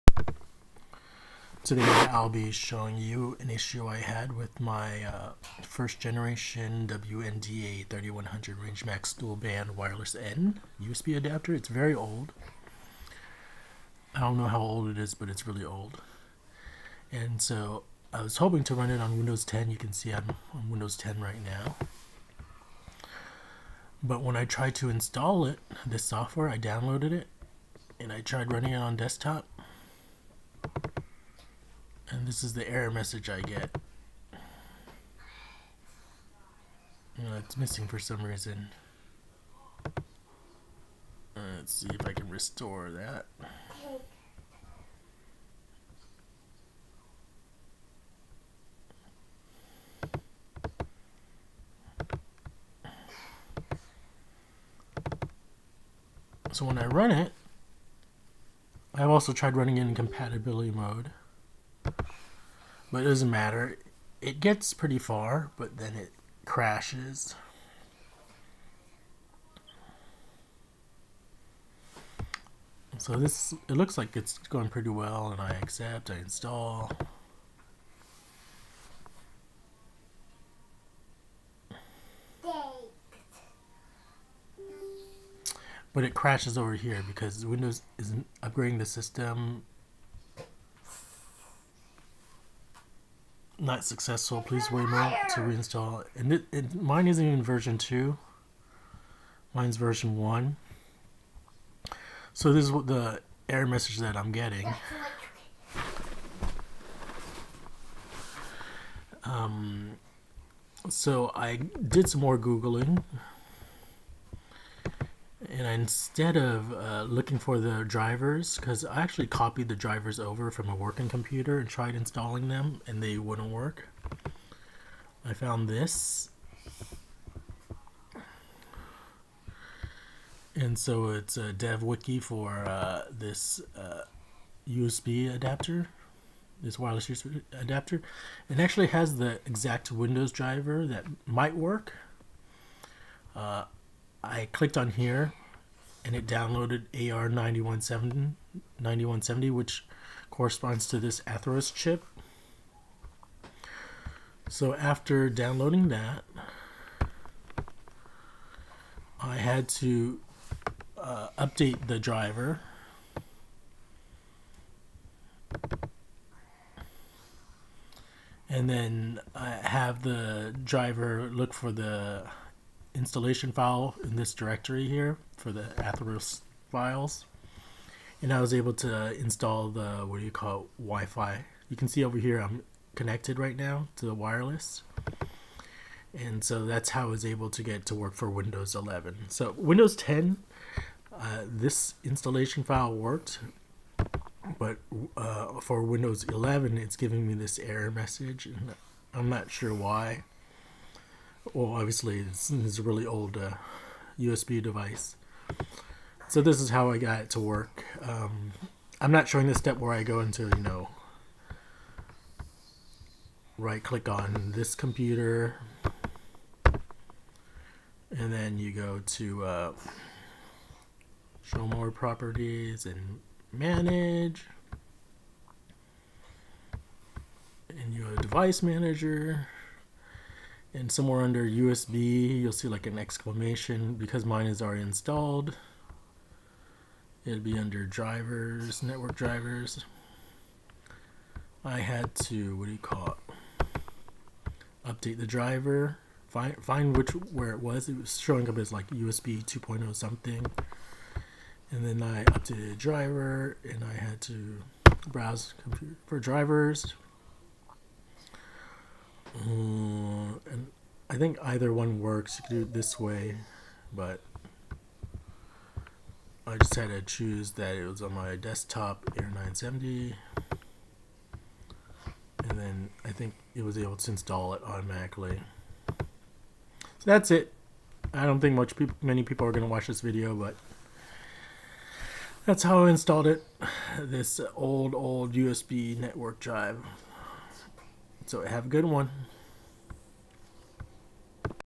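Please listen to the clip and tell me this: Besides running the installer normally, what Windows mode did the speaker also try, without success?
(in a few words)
Compatibility mode.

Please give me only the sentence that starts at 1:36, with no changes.
And it, it, mine isn't even version 2.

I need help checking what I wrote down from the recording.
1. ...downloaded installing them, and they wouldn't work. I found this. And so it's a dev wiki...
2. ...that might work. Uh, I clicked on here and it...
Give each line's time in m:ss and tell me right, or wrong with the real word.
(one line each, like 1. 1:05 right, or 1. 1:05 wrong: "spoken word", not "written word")
1. 2:01 wrong: "tried", not "downloaded"
2. 2:20 right.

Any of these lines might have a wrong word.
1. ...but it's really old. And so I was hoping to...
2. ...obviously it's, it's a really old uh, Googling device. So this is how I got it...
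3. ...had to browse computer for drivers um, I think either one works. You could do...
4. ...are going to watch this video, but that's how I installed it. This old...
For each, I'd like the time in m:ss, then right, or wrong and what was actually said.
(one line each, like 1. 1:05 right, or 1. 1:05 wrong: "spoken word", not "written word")
1. 0:15 right
2. 3:21 wrong: "USB", not "Googling"
3. 4:14 right
4. 4:39 right.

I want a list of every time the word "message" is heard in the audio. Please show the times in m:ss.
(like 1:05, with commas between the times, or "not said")
0:32, 1:43, 3:17.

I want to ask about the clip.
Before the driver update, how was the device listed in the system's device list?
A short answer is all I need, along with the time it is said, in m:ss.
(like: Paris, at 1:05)
USB 2.0 something, at 4:08.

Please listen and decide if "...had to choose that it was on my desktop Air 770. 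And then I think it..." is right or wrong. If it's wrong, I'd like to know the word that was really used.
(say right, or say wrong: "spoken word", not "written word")
wrong: "970", not "770".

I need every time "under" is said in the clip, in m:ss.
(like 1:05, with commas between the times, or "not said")
3:51, 3:57.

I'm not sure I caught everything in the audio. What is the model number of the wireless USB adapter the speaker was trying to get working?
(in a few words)
WNDA 3100.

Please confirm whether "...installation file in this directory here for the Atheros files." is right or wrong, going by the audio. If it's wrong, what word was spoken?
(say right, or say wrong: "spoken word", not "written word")
right.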